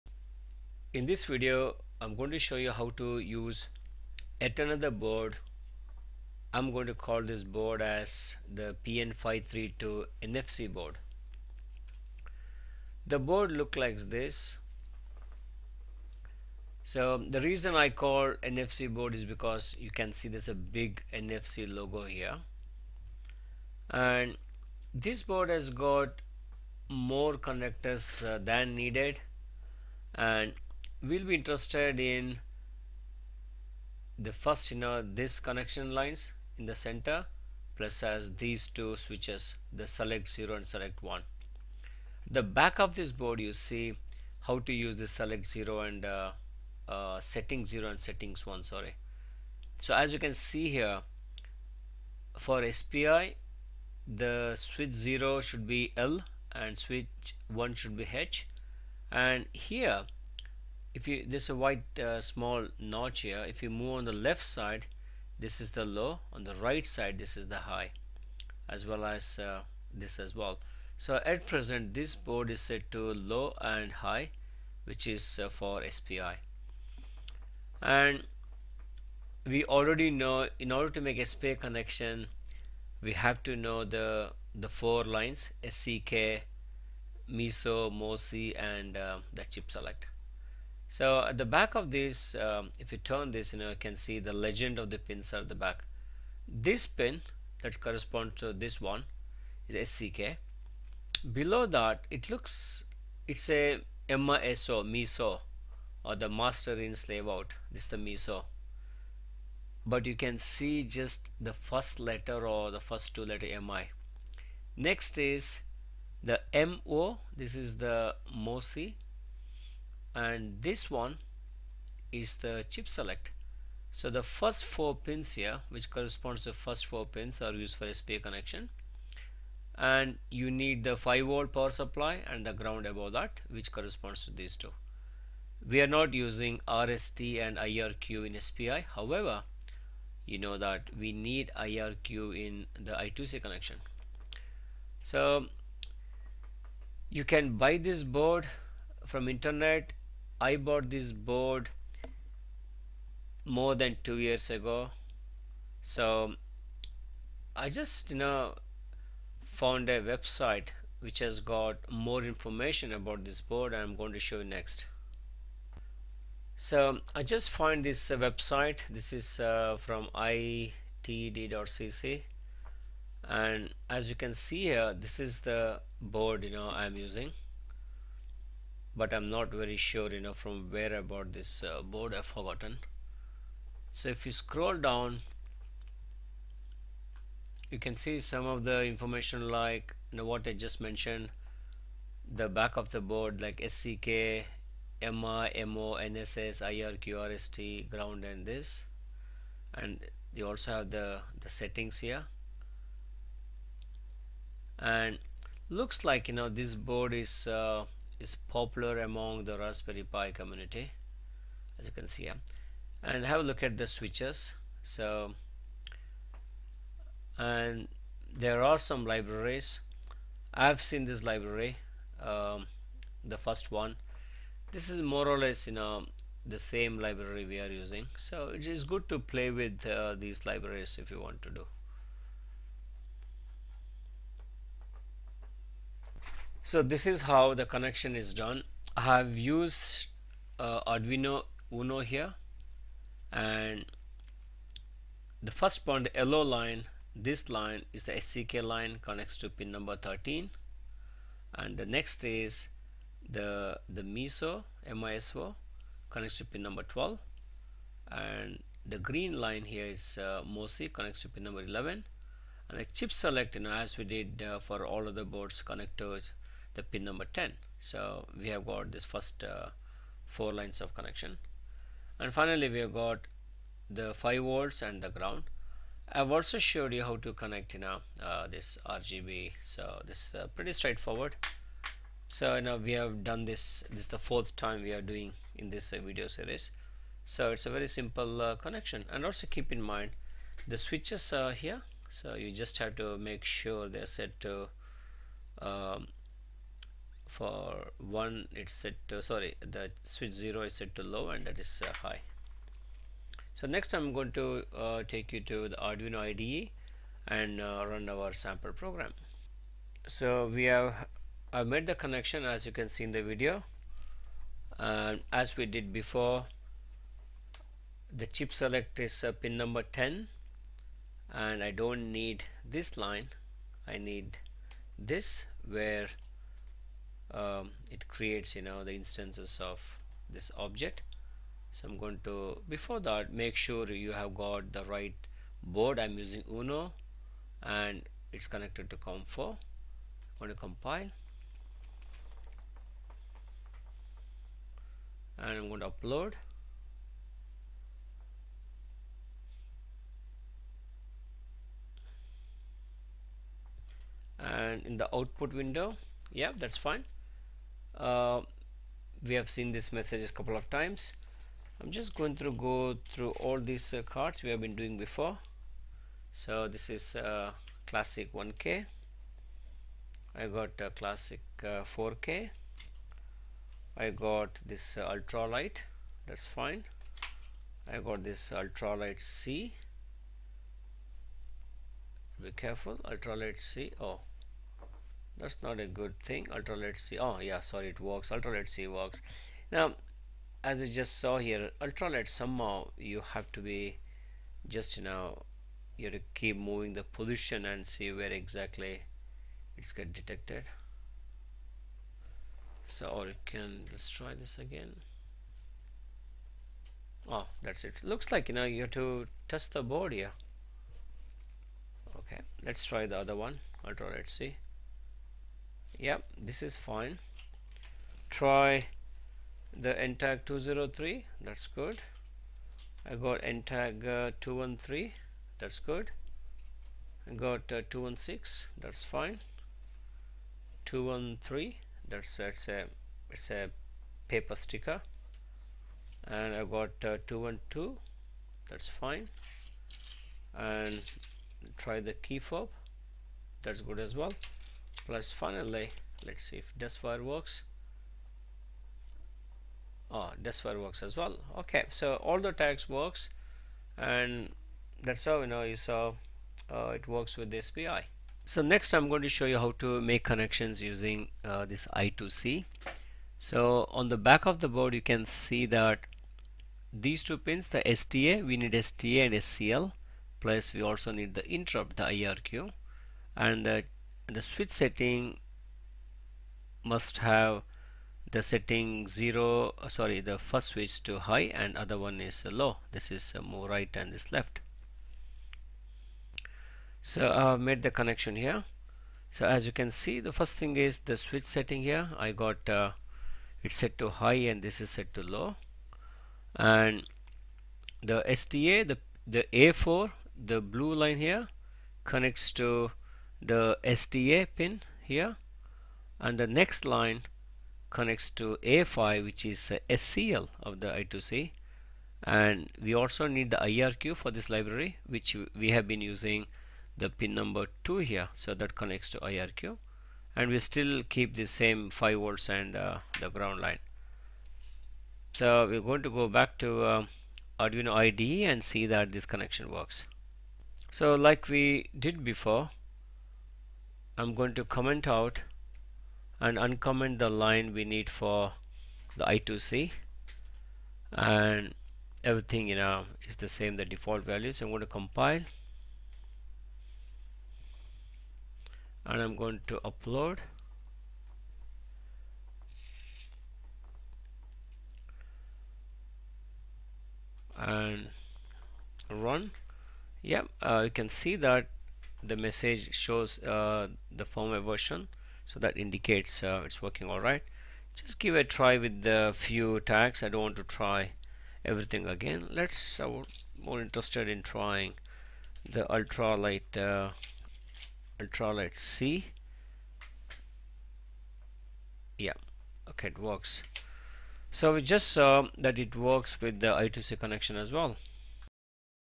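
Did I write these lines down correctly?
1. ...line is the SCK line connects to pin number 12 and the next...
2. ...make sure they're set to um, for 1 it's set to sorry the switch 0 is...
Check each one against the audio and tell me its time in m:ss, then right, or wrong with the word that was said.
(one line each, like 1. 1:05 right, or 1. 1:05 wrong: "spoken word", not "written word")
1. 4:07 wrong: "13", not "12"
2. 4:53 right.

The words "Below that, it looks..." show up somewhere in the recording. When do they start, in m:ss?
1:41.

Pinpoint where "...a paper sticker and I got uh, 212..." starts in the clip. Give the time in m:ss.
7:13.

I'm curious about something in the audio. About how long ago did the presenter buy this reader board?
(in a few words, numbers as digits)
More than two years.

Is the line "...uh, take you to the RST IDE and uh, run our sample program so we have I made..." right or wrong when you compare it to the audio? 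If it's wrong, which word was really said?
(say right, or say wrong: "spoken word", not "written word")
wrong: "Arduino", not "RST".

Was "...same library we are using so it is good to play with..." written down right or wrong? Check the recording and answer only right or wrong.
right.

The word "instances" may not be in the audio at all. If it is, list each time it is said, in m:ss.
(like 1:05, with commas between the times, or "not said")
5:28.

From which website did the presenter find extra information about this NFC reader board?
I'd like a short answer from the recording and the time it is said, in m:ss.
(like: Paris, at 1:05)
itd.cc, at 2:50.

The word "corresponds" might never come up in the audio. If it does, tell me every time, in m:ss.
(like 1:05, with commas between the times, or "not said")
1:37, 2:05, 2:13.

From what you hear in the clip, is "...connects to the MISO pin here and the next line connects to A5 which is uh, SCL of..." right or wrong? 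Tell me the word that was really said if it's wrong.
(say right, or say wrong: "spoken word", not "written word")
wrong: "SDA", not "MISO".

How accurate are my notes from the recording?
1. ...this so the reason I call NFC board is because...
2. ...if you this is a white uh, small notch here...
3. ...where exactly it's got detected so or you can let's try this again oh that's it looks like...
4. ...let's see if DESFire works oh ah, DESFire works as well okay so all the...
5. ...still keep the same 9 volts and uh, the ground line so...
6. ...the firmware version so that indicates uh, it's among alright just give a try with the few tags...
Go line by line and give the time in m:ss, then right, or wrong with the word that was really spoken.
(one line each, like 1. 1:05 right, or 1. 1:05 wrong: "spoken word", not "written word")
1. 0:14 right
2. 1:00 right
3. 6:38 right
4. 7:26 right
5. 8:40 wrong: "5", not "9"
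6. 9:24 wrong: "working", not "among".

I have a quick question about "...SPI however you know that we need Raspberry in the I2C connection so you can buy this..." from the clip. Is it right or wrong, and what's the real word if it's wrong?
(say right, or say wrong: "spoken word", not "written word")
wrong: "IRQ", not "Raspberry".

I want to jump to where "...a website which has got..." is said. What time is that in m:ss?
2:39.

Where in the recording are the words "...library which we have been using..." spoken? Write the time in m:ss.
8:34.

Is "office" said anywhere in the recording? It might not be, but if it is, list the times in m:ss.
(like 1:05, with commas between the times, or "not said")
not said.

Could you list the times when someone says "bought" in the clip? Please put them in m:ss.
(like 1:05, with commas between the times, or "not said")
2:30, 3:01.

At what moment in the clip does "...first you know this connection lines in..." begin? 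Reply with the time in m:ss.
0:34.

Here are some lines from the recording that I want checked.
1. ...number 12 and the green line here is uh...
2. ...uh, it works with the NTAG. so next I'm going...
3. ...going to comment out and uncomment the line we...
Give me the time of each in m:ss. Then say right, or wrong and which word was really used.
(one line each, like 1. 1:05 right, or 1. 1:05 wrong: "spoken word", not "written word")
1. 4:16 right
2. 7:36 wrong: "SPI", not "NTAG"
3. 8:54 right.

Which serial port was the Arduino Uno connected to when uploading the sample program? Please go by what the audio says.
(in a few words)
COM4.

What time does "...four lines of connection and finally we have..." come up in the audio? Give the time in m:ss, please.
4:30.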